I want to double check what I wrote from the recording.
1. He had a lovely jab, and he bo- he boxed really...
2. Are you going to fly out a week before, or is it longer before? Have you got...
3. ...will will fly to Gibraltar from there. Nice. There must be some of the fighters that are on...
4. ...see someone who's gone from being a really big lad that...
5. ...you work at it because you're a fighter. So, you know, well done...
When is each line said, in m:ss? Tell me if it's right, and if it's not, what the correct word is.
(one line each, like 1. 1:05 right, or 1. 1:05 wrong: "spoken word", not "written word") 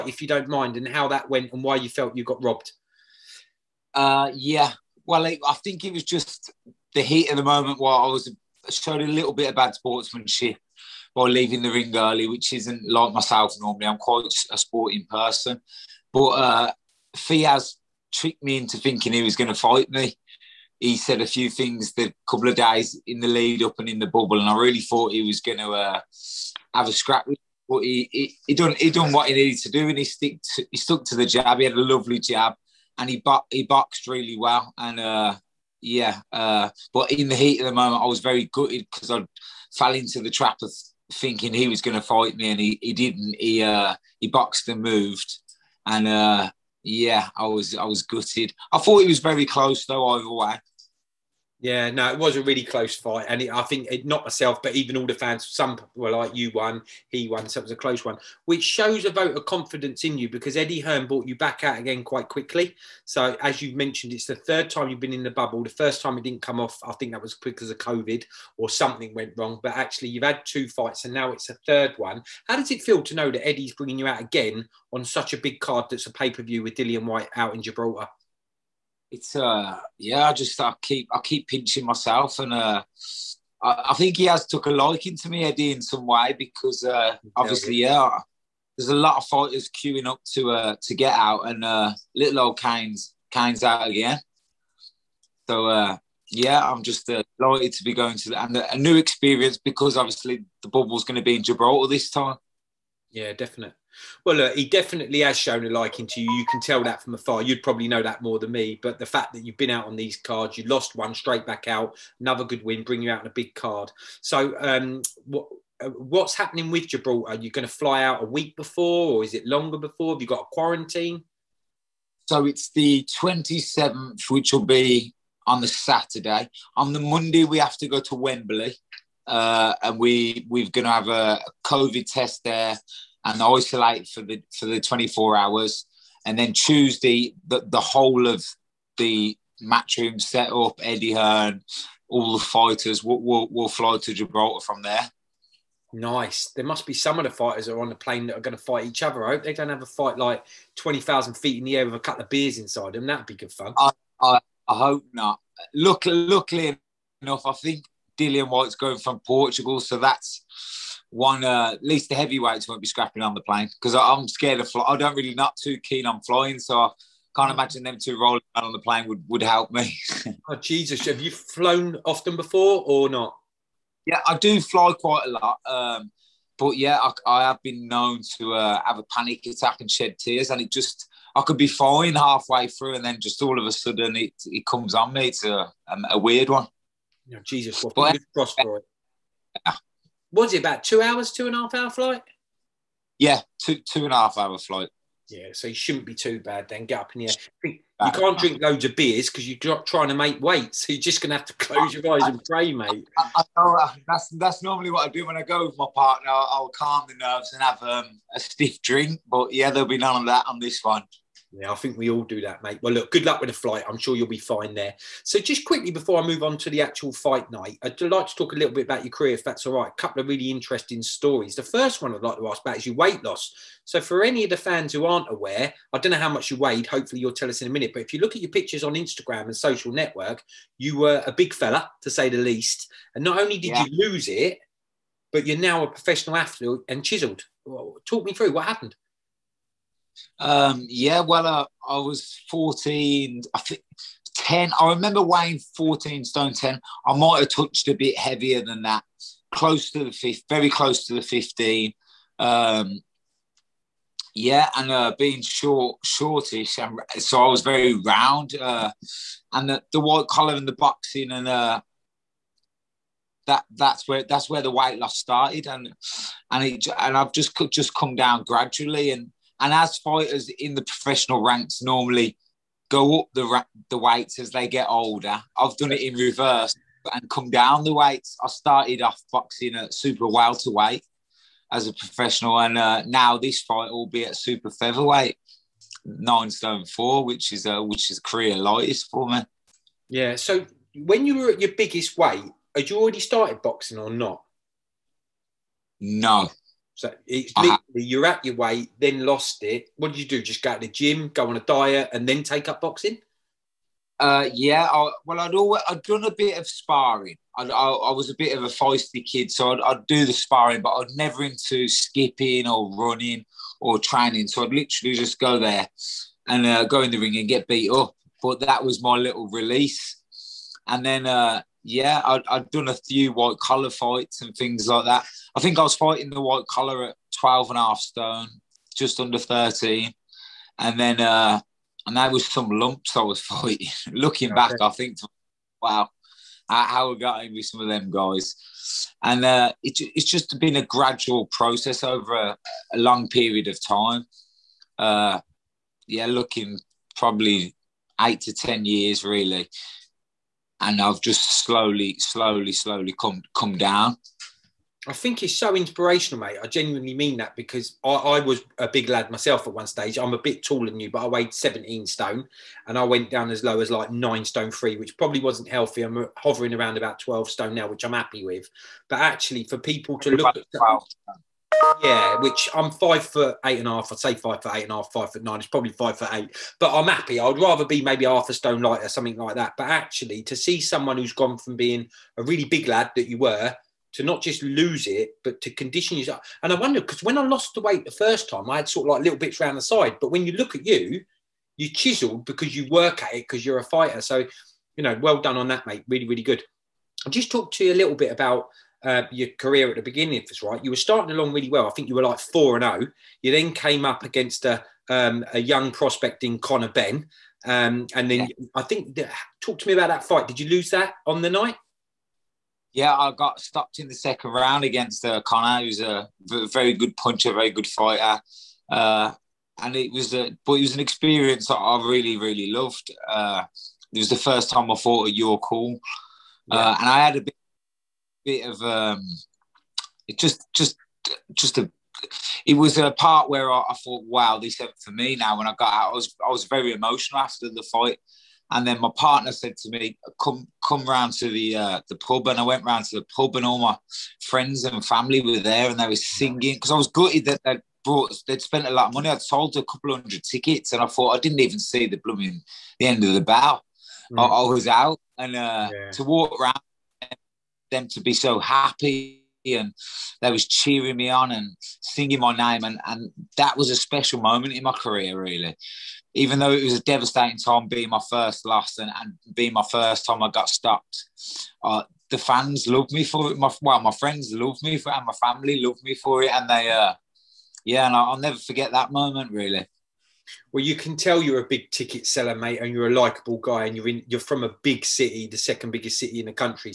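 1. 0:31 right
2. 1:57 right
3. 2:23 right
4. 6:20 right
5. 6:32 right.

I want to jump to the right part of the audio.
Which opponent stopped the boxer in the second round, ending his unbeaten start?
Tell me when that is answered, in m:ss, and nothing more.
6:46.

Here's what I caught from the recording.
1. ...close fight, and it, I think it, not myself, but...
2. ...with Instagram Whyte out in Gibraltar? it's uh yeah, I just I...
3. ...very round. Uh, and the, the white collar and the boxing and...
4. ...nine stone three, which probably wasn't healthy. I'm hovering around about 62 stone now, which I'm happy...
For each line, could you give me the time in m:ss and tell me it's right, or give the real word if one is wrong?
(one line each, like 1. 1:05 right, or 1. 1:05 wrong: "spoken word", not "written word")
1. 0:52 right
2. 1:16 wrong: "Dillian", not "Instagram"
3. 4:17 right
4. 6:04 wrong: "12", not "62".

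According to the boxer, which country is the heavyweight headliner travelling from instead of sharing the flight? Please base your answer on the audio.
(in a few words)
Portugal.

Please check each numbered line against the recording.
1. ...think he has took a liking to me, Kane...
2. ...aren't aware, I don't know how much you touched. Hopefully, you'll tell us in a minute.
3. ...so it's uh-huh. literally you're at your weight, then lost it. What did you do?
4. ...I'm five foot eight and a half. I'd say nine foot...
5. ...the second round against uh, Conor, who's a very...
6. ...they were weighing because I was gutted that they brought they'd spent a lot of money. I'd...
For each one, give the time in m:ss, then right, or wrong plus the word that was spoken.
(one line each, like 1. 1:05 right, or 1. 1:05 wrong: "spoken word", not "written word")
1. 1:23 wrong: "Eddie", not "Kane"
2. 3:45 wrong: "weighed", not "touched"
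3. 4:56 right
4. 6:12 wrong: "five", not "nine"
5. 6:54 right
6. 7:25 wrong: "singing", not "weighing".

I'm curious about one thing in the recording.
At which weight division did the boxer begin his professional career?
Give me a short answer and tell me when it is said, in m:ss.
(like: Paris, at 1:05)
Super welterweight, at 4:39.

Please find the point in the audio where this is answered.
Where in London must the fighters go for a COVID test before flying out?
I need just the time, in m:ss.
2:08.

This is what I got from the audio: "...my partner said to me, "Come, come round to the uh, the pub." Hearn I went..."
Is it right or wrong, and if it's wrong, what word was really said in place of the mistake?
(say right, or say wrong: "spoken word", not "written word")
wrong: "And", not "Hearn".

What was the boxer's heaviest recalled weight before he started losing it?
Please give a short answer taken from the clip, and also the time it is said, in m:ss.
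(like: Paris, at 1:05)
14 stone 10, at 4:02.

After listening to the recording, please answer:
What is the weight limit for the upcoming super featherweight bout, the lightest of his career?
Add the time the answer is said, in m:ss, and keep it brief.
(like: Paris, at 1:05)
9 stone 4, at 4:46.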